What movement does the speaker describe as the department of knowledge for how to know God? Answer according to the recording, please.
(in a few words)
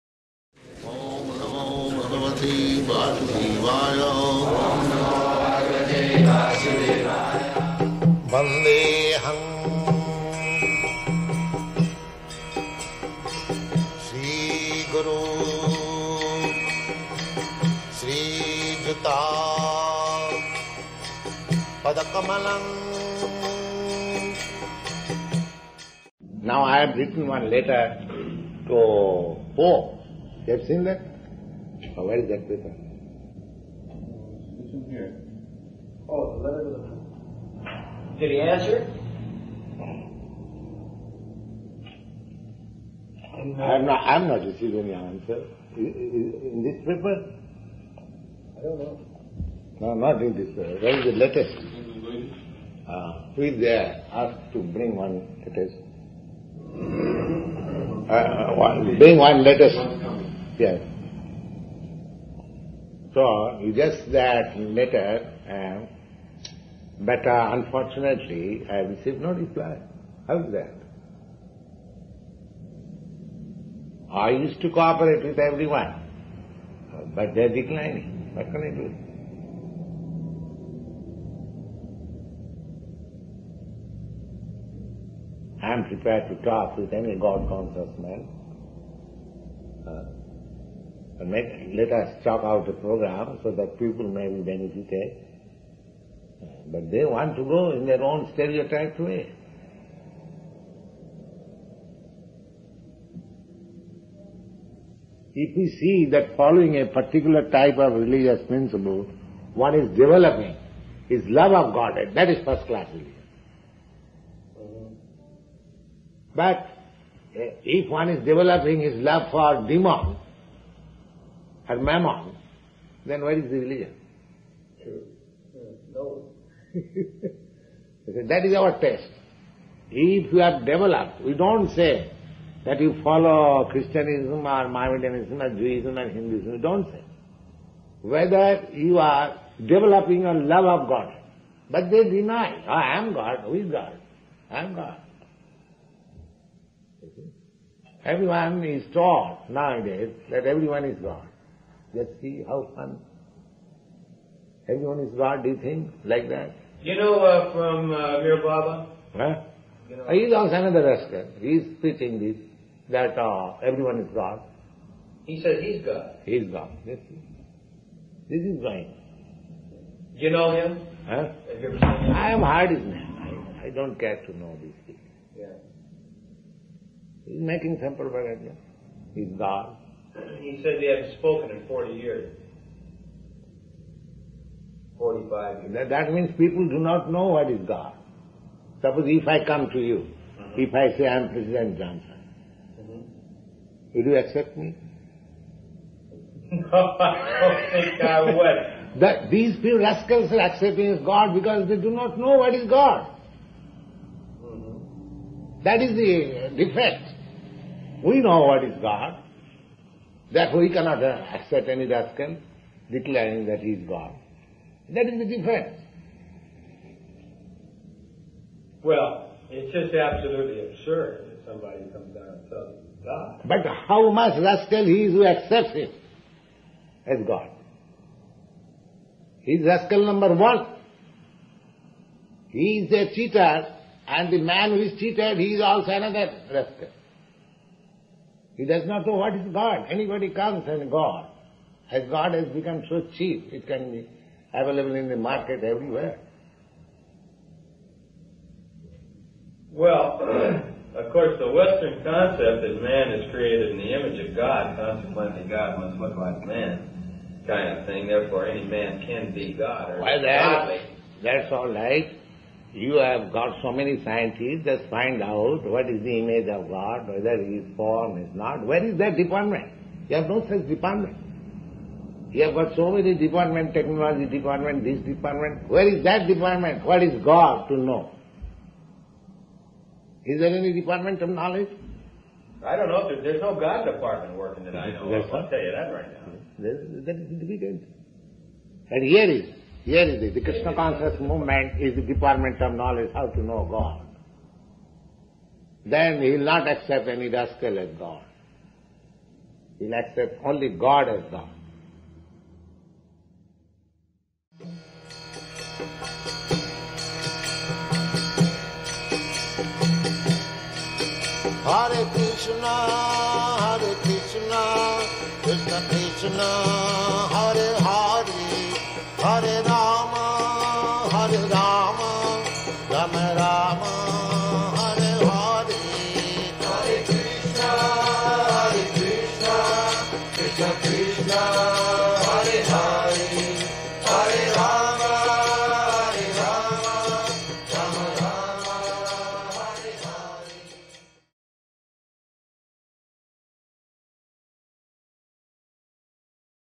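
Krishna conscious movement.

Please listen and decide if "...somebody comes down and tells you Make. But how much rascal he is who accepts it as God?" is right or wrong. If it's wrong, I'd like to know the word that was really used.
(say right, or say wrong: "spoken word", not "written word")
wrong: "God", not "Make".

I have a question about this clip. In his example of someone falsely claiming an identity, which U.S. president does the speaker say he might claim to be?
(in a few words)
President Johnson.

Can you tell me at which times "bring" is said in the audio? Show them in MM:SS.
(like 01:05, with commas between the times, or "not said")
00:54, 00:58.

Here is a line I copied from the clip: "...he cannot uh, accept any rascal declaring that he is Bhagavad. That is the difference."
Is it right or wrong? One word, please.
wrong.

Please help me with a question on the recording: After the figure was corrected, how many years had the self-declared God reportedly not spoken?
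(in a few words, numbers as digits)
45.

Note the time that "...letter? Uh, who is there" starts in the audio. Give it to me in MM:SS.
00:51.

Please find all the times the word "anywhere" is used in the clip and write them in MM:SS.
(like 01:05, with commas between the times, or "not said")
not said.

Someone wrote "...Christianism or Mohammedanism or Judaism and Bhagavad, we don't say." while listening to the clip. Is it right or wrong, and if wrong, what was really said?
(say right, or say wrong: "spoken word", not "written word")
wrong: "Hinduism", not "Bhagavad".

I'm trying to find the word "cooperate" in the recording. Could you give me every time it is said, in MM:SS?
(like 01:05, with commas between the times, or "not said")
01:14.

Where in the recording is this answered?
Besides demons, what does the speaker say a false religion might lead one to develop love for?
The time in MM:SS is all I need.
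02:01.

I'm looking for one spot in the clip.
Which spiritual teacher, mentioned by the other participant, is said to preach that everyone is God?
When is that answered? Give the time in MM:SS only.
02:38.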